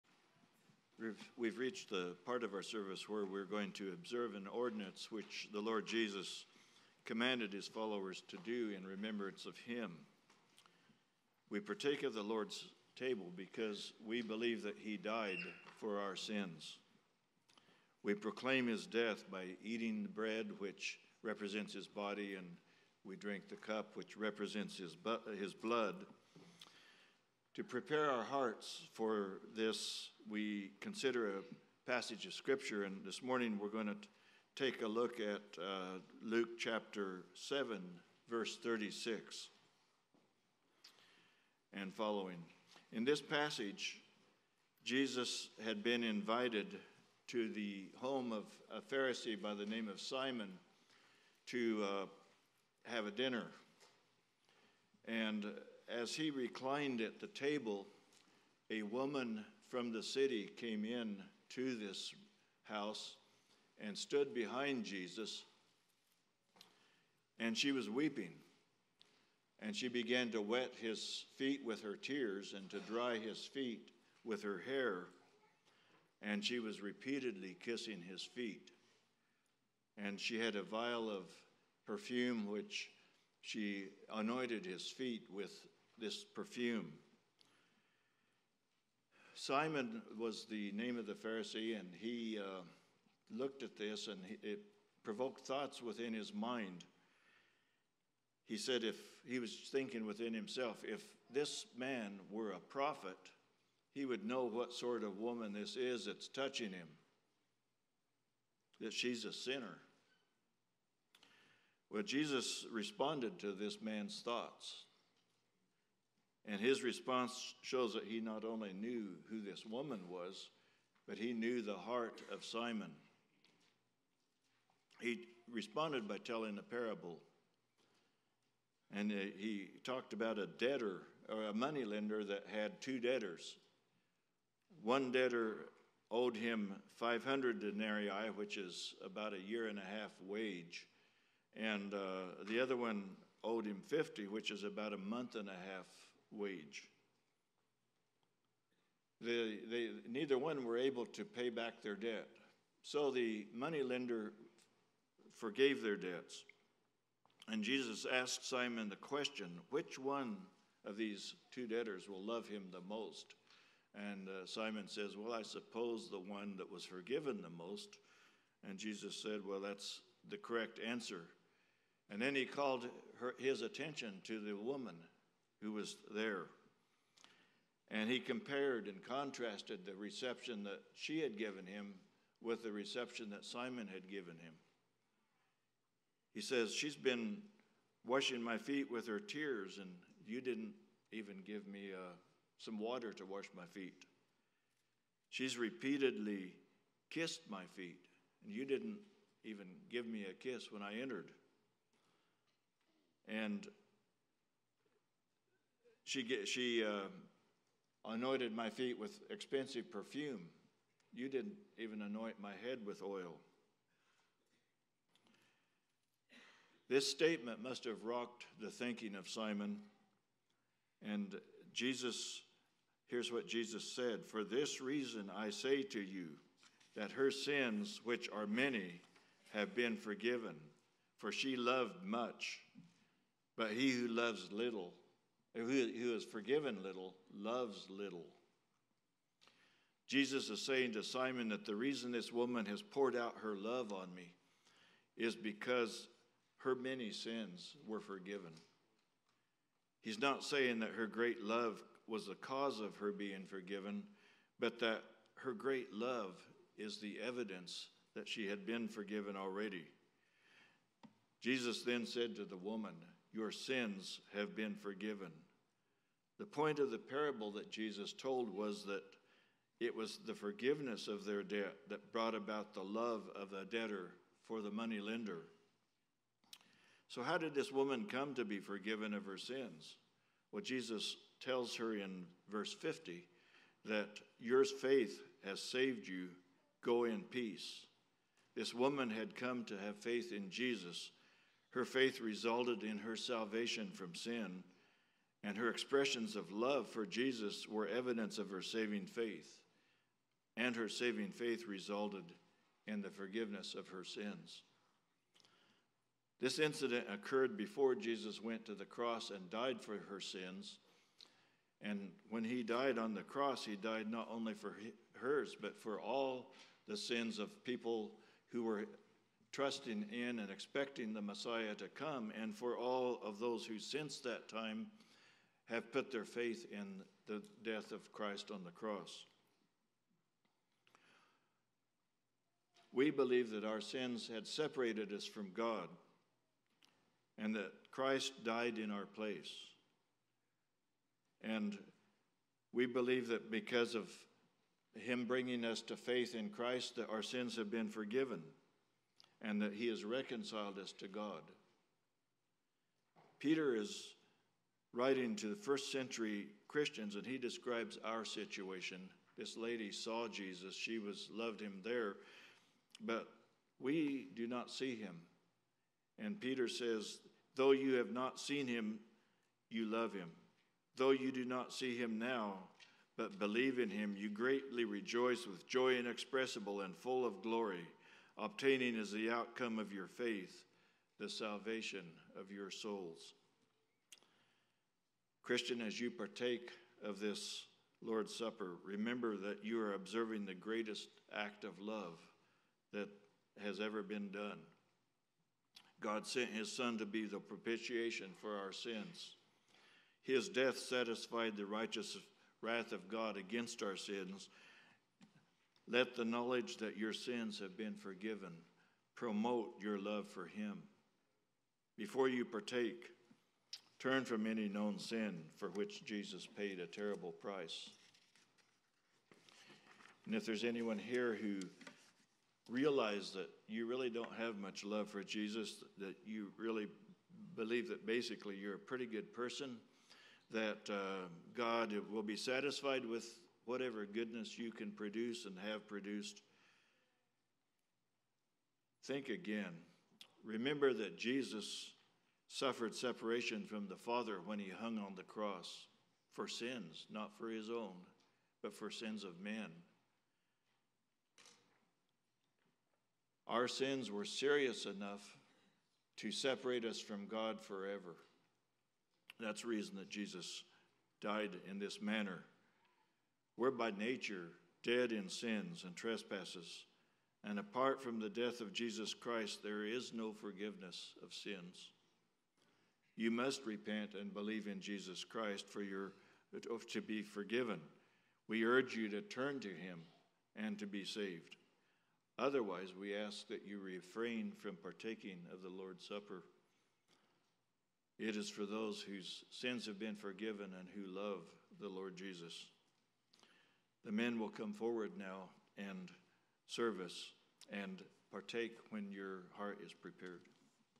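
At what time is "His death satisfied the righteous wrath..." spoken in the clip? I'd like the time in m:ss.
6:40.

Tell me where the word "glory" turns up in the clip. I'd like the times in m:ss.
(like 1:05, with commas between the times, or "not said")
6:17.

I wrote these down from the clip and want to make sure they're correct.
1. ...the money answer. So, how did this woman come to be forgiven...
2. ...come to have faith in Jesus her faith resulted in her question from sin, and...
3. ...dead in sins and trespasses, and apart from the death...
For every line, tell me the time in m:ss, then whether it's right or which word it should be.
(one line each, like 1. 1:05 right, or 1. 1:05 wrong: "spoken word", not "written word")
1. 4:34 wrong: "lender", not "answer"
2. 4:49 wrong: "salvation", not "question"
3. 7:44 right.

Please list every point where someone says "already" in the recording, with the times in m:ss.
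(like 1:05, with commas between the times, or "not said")
4:19.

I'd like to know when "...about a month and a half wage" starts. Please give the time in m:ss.
2:24.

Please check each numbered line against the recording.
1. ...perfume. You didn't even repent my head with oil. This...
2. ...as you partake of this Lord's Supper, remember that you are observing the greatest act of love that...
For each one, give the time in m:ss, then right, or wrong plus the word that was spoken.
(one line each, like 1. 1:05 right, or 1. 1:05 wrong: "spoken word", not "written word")
1. 3:29 wrong: "anoint", not "repent"
2. 6:25 right.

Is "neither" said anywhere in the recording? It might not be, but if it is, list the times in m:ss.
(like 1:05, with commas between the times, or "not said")
2:30.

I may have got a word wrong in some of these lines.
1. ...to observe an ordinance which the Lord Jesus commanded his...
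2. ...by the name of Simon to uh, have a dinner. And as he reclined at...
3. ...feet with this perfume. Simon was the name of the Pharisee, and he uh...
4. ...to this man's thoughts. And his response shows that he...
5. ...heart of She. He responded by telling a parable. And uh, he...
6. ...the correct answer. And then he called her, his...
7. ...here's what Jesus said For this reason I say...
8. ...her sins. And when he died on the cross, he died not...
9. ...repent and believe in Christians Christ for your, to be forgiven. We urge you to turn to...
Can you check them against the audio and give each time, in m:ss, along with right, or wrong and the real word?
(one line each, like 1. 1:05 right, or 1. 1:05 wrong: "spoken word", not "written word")
1. 0:03 right
2. 0:49 right
3. 1:24 right
4. 1:53 right
5. 2:01 wrong: "Simon", not "She"
6. 2:50 right
7. 3:43 right
8. 5:10 right
9. 7:53 wrong: "Jesus", not "Christians".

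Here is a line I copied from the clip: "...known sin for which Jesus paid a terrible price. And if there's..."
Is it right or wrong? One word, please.
right.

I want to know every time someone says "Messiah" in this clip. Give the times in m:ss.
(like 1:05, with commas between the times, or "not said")
5:21.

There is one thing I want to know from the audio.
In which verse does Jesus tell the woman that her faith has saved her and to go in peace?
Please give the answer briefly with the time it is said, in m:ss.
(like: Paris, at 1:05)
verse 50, at 4:42.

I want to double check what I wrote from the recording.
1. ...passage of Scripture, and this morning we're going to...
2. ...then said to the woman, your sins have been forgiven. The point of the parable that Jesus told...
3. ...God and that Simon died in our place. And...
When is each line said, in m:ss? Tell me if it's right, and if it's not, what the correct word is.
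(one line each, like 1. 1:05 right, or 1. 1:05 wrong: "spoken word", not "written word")
1. 0:31 right
2. 4:21 right
3. 5:35 wrong: "Christ", not "Simon".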